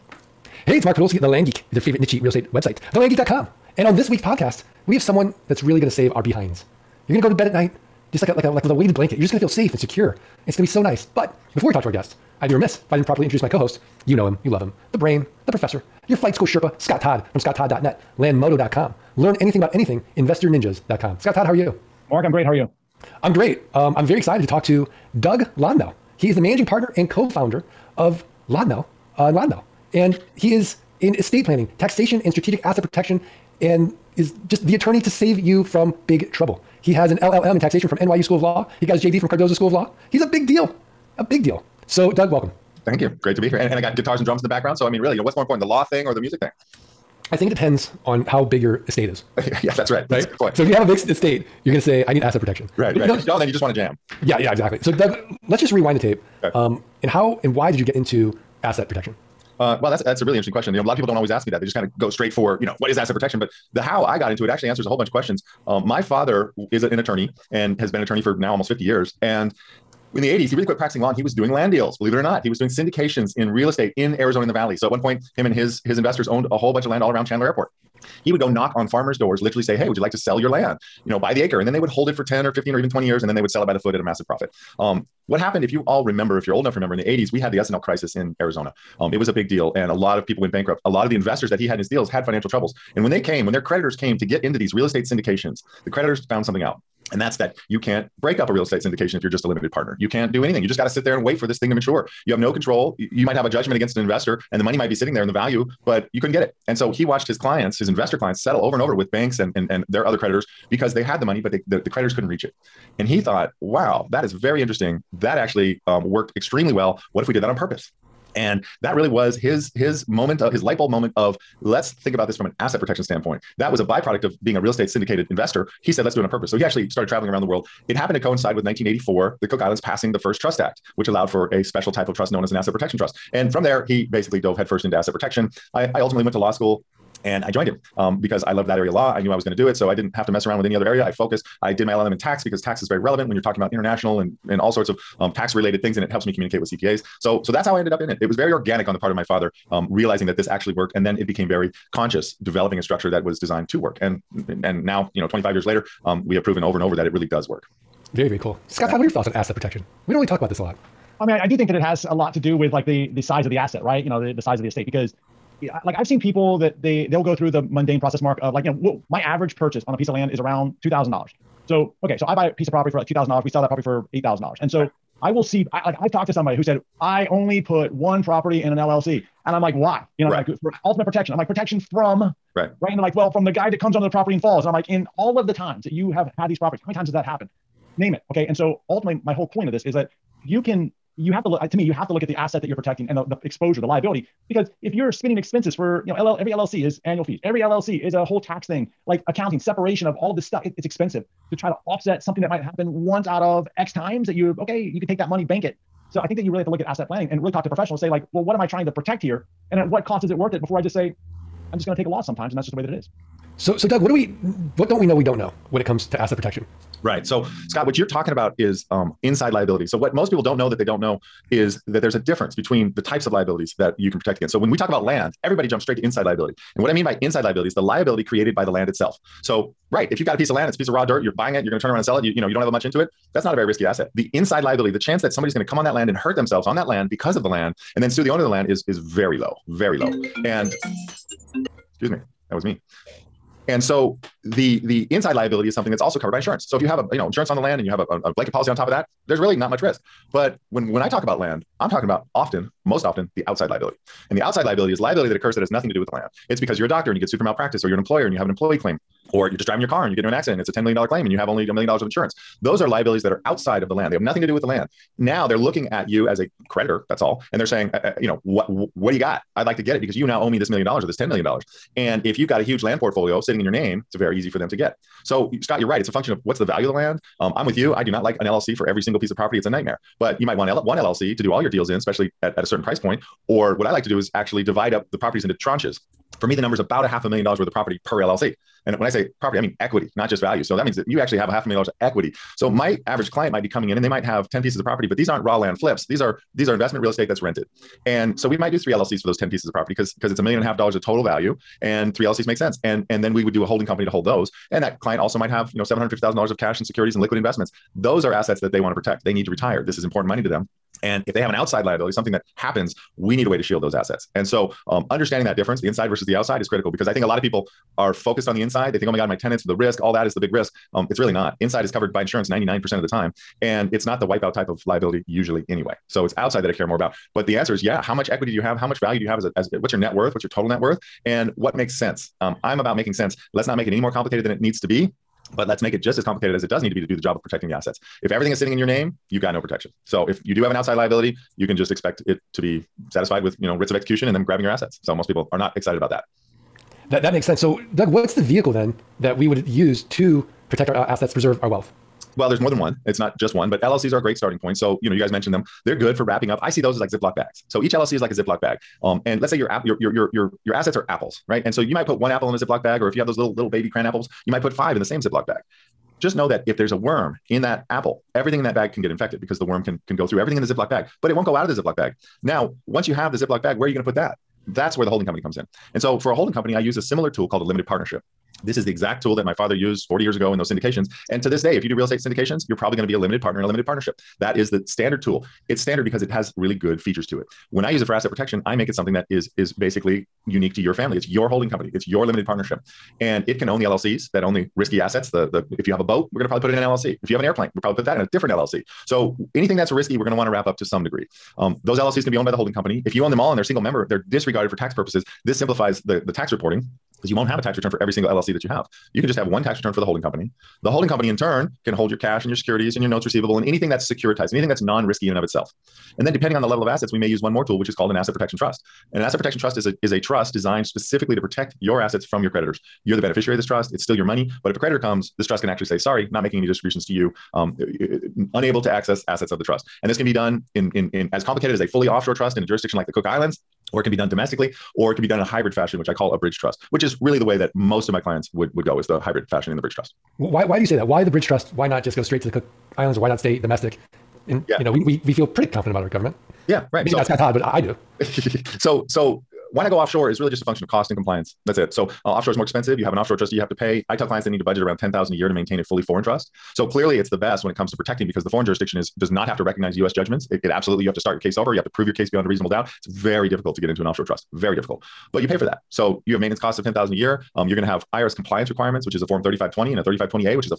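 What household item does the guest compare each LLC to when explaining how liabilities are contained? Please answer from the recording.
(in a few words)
Ziploc bags.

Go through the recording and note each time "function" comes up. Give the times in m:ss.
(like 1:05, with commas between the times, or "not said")
4:36, 7:30.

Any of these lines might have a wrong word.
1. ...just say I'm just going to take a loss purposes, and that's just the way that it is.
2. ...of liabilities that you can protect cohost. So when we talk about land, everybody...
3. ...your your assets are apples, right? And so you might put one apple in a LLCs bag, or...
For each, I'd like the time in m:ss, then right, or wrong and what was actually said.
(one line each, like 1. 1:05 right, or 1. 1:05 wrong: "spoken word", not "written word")
1. 3:30 wrong: "sometimes", not "purposes"
2. 3:43 wrong: "against", not "cohost"
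3. 6:00 wrong: "Ziploc", not "LLCs".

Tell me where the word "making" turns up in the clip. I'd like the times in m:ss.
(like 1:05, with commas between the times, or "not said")
5:32, 7:06.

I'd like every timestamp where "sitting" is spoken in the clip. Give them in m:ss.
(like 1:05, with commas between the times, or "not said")
1:44, 4:33, 5:38.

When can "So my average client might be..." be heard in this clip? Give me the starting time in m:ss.
4:52.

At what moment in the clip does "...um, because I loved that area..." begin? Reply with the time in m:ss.
2:17.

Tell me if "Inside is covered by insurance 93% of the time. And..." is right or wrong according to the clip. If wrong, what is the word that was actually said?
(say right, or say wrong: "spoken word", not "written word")
wrong: "99", not "93".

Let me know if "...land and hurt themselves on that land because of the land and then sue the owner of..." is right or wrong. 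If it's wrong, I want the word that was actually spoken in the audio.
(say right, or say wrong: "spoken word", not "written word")
right.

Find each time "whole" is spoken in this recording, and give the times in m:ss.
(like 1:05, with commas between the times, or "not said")
1:04, 1:16, 3:09, 3:18.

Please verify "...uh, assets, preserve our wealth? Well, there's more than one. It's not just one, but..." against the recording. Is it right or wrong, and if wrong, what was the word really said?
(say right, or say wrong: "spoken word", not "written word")
right.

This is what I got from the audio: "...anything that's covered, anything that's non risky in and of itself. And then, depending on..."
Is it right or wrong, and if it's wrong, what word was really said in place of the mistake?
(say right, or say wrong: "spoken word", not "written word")
wrong: "securitized", not "covered".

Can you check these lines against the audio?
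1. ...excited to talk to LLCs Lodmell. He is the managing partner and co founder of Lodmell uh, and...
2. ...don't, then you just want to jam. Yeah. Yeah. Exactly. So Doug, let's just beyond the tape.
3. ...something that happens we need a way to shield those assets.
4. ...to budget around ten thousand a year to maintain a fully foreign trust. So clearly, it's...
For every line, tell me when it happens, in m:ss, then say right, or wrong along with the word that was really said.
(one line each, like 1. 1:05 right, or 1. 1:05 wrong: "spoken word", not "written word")
1. 0:24 wrong: "Doug", not "LLCs"
2. 0:53 wrong: "rewind", not "beyond"
3. 5:12 right
4. 7:34 right.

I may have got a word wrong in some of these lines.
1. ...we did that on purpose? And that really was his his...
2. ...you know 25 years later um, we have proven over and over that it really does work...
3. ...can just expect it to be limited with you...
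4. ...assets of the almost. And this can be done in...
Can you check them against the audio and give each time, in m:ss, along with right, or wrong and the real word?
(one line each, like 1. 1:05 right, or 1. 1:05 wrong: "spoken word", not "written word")
1. 1:57 right
2. 2:35 right
3. 5:41 wrong: "satisfied", not "limited"
4. 7:09 wrong: "trust", not "almost".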